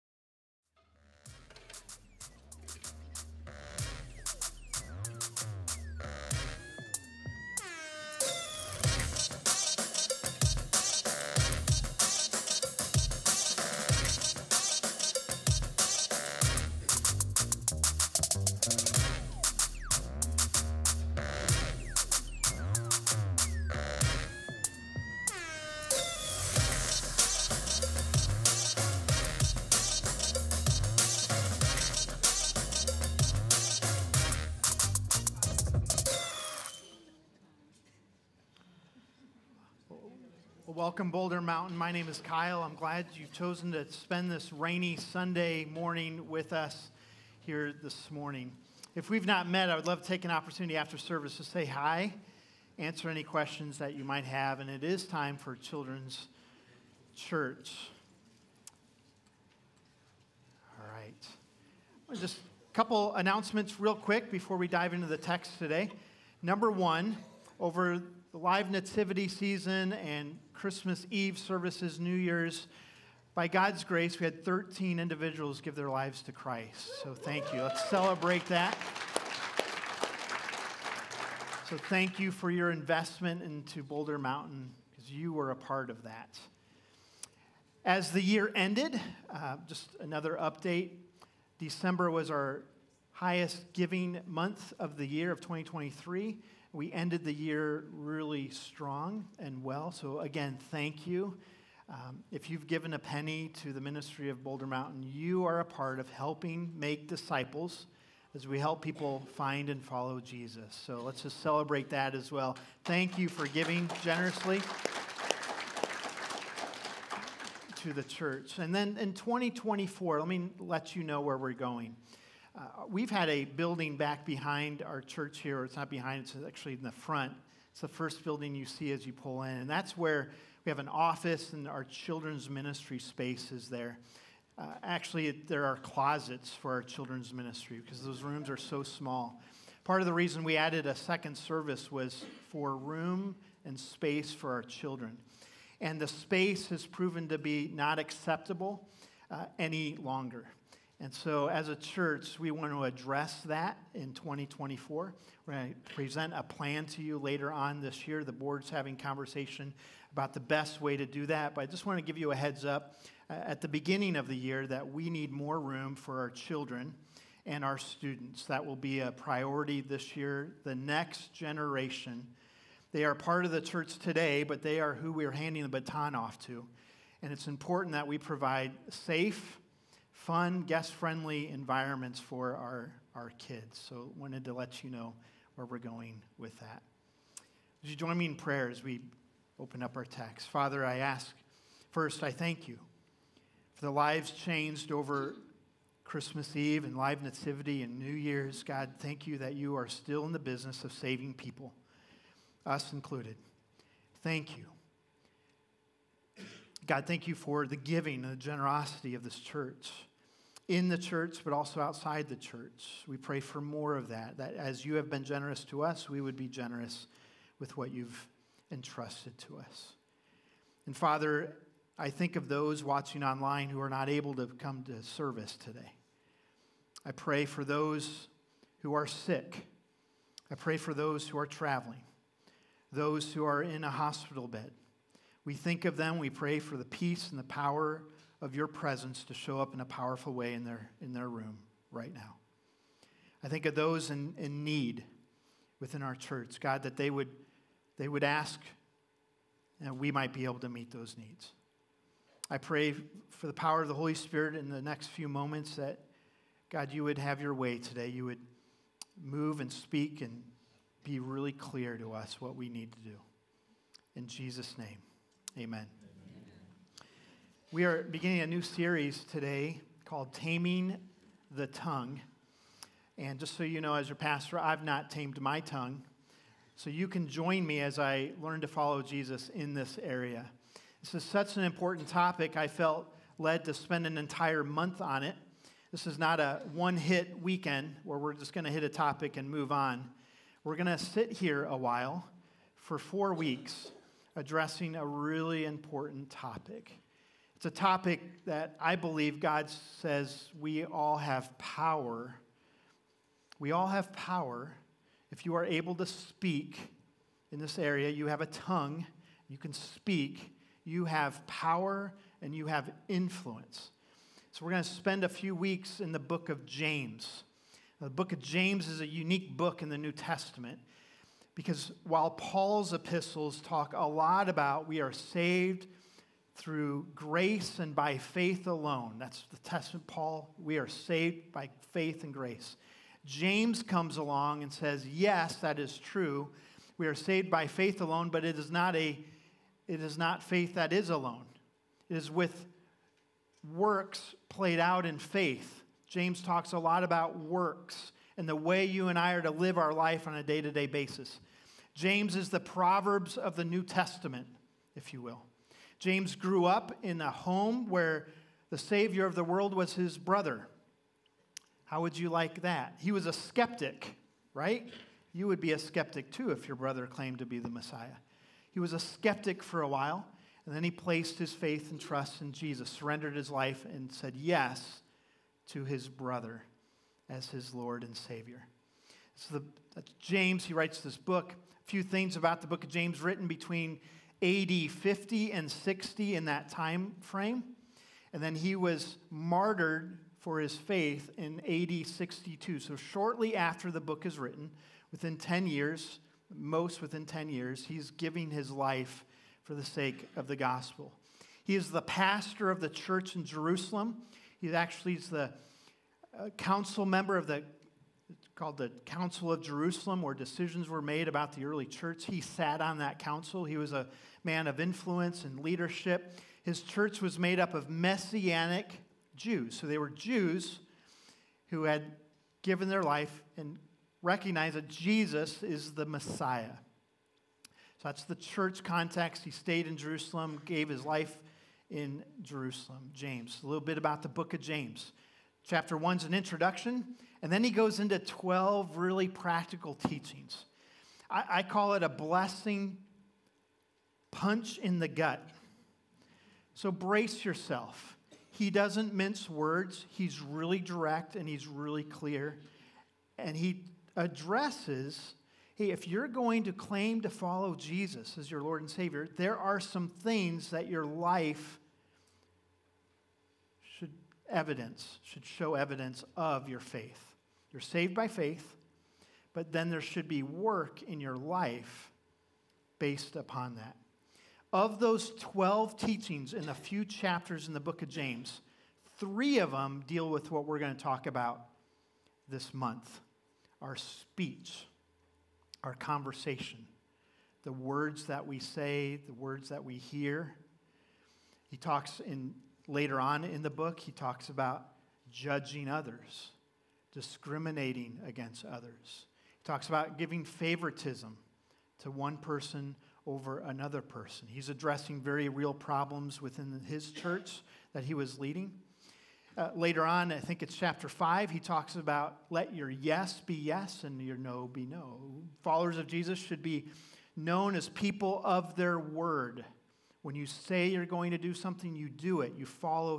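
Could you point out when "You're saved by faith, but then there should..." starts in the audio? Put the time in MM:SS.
07:47.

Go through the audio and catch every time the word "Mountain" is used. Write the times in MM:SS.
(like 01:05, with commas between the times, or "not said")
00:41, 01:24, 01:44.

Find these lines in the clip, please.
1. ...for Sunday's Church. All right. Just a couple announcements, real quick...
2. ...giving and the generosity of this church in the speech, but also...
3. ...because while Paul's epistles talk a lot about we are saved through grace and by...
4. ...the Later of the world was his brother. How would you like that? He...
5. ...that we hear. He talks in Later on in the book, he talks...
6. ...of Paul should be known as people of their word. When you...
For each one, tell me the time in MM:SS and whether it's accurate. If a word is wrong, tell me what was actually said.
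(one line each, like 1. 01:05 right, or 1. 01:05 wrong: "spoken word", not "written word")
1. 00:55 wrong: "Children", not "Sunday"
2. 03:27 wrong: "church", not "speech"
3. 05:21 right
4. 05:58 wrong: "Savior", not "Later"
5. 08:09 right
6. 08:35 wrong: "Jesus", not "Paul".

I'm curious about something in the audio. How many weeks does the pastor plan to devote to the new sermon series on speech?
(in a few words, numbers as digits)
4.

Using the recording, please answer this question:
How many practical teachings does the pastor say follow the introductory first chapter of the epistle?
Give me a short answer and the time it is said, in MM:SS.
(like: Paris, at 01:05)
12, at 07:18.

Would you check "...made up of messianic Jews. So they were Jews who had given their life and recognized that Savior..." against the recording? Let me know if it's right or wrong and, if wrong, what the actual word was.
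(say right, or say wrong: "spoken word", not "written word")
wrong: "Jesus", not "Savior".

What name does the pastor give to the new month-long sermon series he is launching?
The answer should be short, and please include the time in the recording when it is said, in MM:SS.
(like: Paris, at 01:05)
Taming the Tongue, at 04:30.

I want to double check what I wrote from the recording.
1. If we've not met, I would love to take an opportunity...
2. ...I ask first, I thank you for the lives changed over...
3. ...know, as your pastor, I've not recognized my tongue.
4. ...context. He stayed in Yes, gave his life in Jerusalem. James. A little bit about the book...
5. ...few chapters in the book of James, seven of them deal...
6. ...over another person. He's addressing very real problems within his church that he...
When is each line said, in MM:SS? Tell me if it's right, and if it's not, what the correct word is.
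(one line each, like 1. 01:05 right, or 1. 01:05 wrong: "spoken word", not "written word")
1. 00:48 right
2. 03:10 right
3. 04:33 wrong: "tamed", not "recognized"
4. 07:08 wrong: "Jerusalem", not "Yes"
5. 07:56 wrong: "three", not "seven"
6. 08:23 right.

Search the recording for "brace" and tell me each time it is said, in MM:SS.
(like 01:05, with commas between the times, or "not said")
07:26.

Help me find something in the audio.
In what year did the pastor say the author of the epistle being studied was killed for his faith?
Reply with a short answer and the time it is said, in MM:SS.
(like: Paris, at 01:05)
AD 62, at 06:31.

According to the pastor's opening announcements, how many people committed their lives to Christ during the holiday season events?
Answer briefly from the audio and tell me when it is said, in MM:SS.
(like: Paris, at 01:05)
13, at 01:14.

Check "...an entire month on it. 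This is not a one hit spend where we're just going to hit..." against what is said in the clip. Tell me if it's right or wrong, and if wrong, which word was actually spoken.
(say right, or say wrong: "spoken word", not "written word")
wrong: "weekend", not "spend".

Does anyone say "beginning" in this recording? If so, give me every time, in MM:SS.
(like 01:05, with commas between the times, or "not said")
02:43, 04:28.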